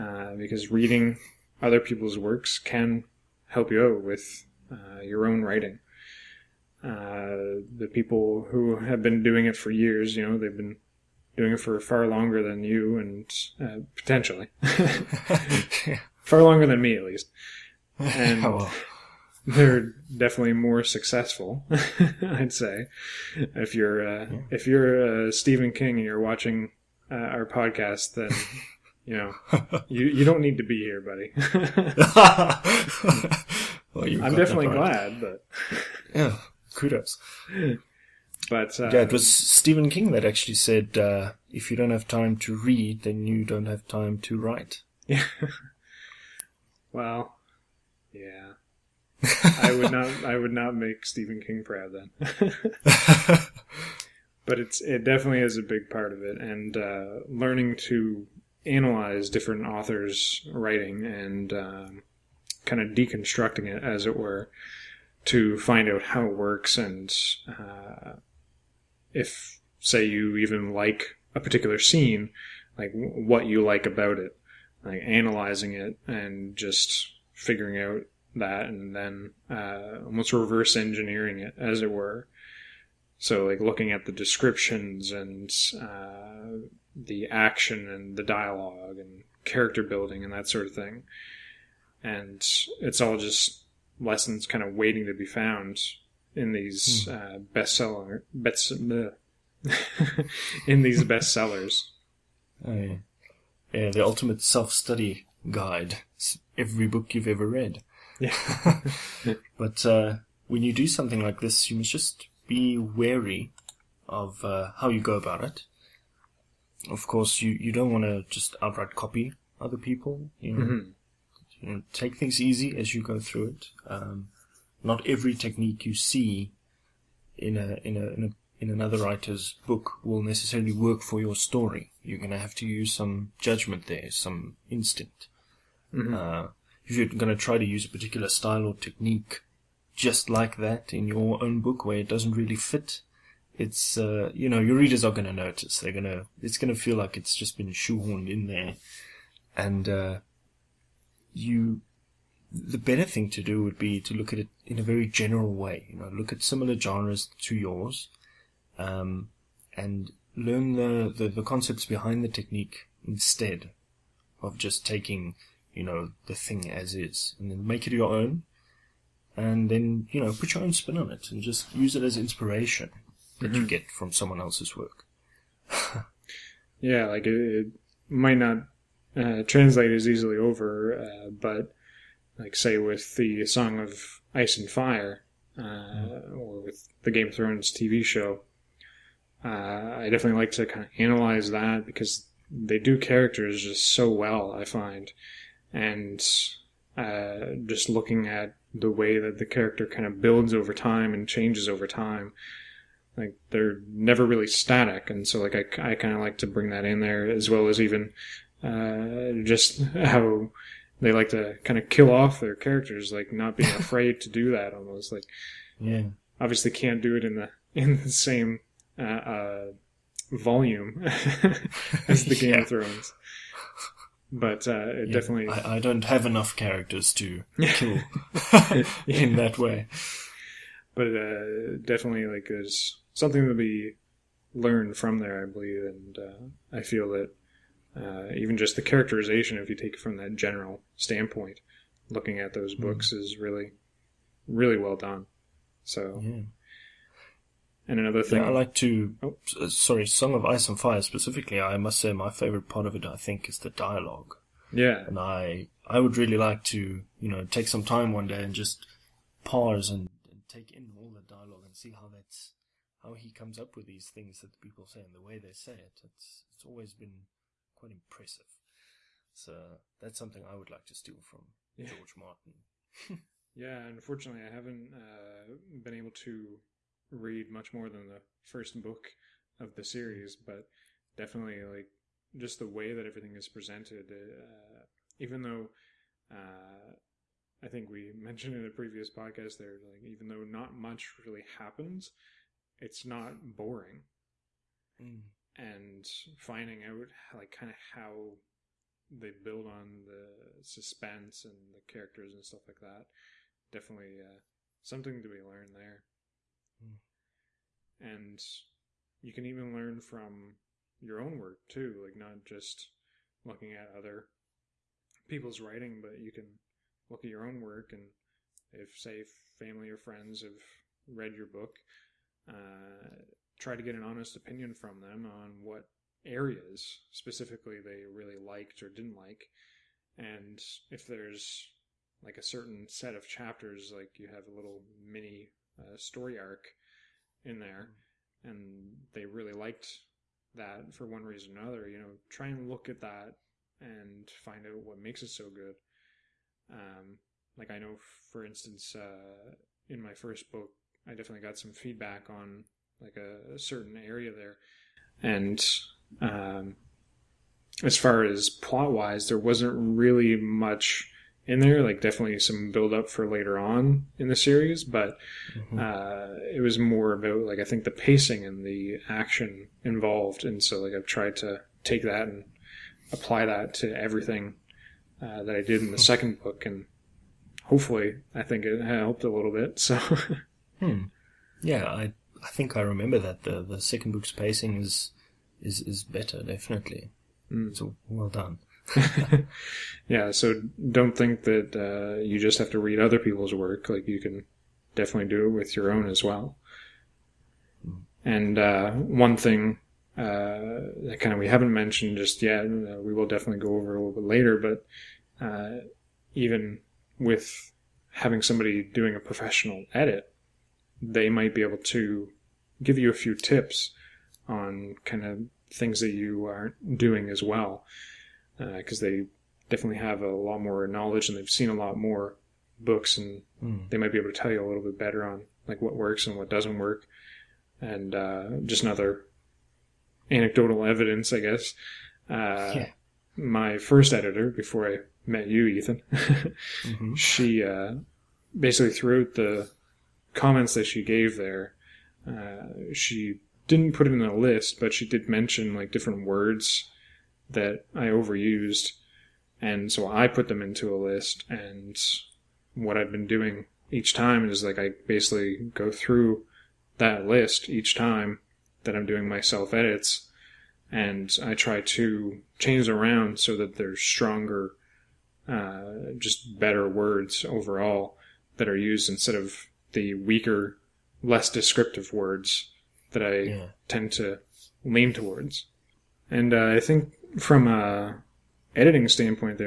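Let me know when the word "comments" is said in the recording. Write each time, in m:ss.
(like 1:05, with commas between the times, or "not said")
7:20.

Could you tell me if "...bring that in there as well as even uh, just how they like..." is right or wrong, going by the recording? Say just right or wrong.
right.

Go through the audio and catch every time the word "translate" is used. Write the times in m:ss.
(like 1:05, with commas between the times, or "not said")
2:59.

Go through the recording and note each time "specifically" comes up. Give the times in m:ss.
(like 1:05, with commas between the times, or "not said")
4:11, 5:27.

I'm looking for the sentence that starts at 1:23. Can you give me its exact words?
So, like looking at the descriptions and uh, the action and the dialogue and character building and that sort of thing.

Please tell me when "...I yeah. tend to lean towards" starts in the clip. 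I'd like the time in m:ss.
7:53.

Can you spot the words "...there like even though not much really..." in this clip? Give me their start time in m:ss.
4:49.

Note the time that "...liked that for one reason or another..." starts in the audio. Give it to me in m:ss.
5:39.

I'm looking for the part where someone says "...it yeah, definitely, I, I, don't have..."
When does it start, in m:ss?
3:44.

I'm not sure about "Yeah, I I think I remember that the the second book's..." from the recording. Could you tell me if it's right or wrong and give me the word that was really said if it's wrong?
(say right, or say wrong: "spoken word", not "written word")
right.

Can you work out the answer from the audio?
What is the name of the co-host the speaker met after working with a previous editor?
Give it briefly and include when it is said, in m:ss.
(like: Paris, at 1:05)
Ethan, at 7:15.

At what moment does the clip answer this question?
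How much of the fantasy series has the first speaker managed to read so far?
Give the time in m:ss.
4:38.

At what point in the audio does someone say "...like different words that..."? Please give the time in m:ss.
7:25.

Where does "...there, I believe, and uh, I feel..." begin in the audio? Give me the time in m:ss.
3:55.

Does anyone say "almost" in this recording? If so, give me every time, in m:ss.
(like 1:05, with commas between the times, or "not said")
1:20, 3:34.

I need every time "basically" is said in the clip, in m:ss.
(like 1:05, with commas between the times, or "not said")
7:18, 7:35.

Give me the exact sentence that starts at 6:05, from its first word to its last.
uh, it was more about like I think the pacing and the action involved.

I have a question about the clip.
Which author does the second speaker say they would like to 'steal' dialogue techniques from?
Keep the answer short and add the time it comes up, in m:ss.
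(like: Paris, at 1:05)
George Martin, at 4:31.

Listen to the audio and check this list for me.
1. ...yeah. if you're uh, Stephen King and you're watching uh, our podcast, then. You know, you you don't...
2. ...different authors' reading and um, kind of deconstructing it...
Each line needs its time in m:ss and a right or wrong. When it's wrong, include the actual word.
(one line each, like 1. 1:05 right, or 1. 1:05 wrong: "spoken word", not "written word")
1. 0:24 right
2. 0:59 wrong: "writing", not "reading".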